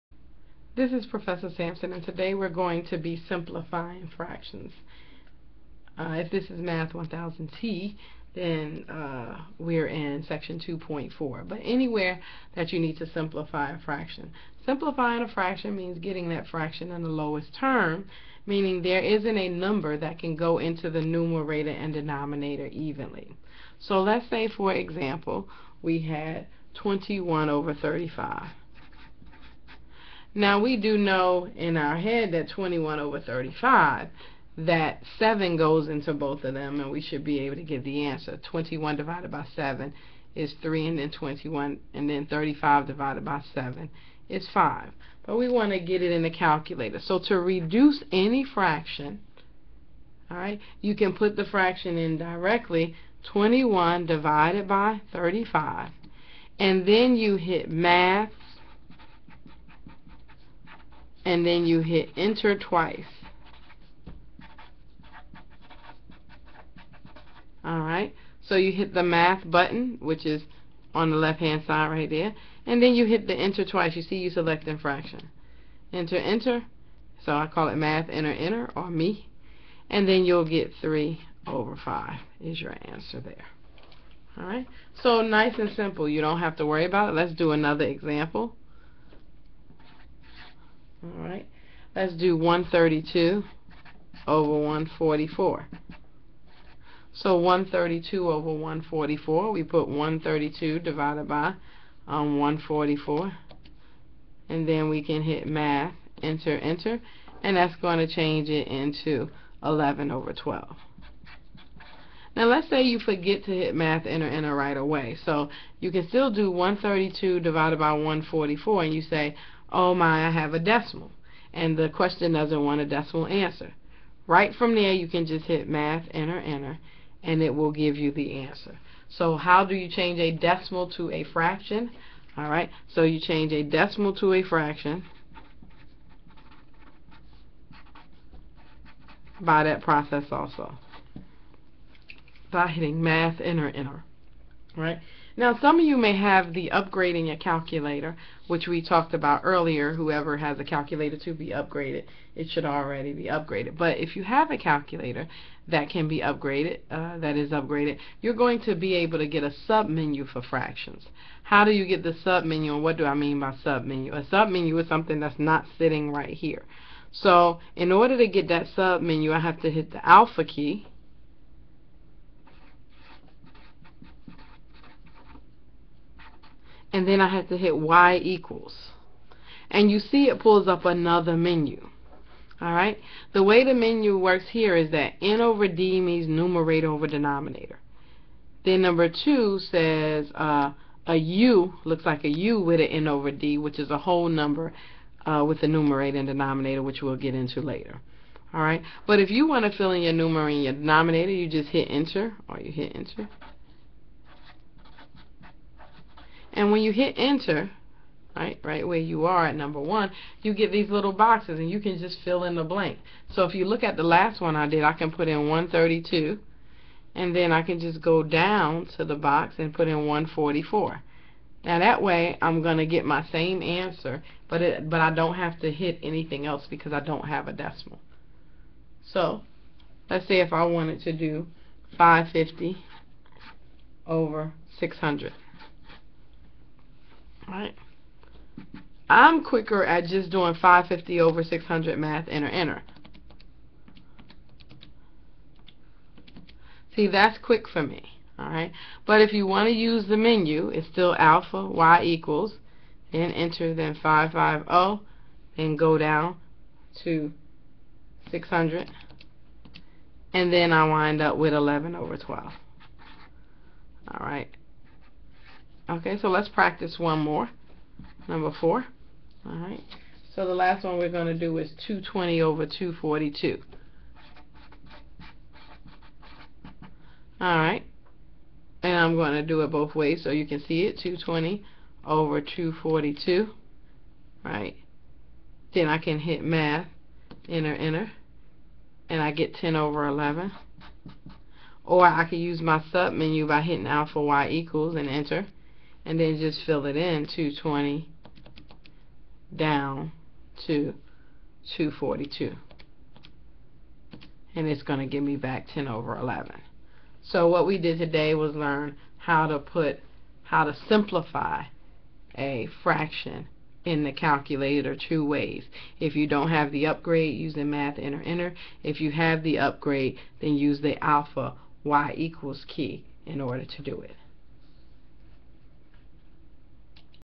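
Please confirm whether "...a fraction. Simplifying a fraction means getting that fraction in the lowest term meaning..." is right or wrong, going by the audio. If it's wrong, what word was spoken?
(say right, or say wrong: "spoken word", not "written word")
right.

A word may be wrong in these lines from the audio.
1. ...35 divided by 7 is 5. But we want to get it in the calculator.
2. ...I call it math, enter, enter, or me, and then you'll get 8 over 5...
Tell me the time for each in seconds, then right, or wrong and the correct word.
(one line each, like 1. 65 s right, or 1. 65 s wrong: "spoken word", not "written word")
1. 42 s right
2. 77 s wrong: "3", not "8".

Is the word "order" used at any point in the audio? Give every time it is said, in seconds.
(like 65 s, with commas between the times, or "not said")
167 s, 323 s.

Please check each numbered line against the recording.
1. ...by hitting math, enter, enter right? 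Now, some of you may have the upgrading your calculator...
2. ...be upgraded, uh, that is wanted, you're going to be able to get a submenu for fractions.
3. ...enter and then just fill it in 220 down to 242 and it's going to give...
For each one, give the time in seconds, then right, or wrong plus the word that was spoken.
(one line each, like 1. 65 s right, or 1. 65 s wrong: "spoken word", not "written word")
1. 142 s right
2. 156 s wrong: "upgraded", not "wanted"
3. 295 s right.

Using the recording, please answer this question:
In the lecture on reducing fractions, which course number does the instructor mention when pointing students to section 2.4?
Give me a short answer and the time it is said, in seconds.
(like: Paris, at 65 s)
Math 1000T, at 6 s.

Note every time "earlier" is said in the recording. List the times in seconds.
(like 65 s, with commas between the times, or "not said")
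149 s.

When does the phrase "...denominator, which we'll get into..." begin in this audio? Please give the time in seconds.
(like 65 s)
196 s.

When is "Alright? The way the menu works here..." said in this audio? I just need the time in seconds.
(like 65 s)
182 s.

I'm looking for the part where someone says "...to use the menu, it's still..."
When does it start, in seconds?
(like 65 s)
249 s.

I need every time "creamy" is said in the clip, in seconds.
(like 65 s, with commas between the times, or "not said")
not said.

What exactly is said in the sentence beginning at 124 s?
Right from there, you can just hit math, enter, enter, and it will give you the answer.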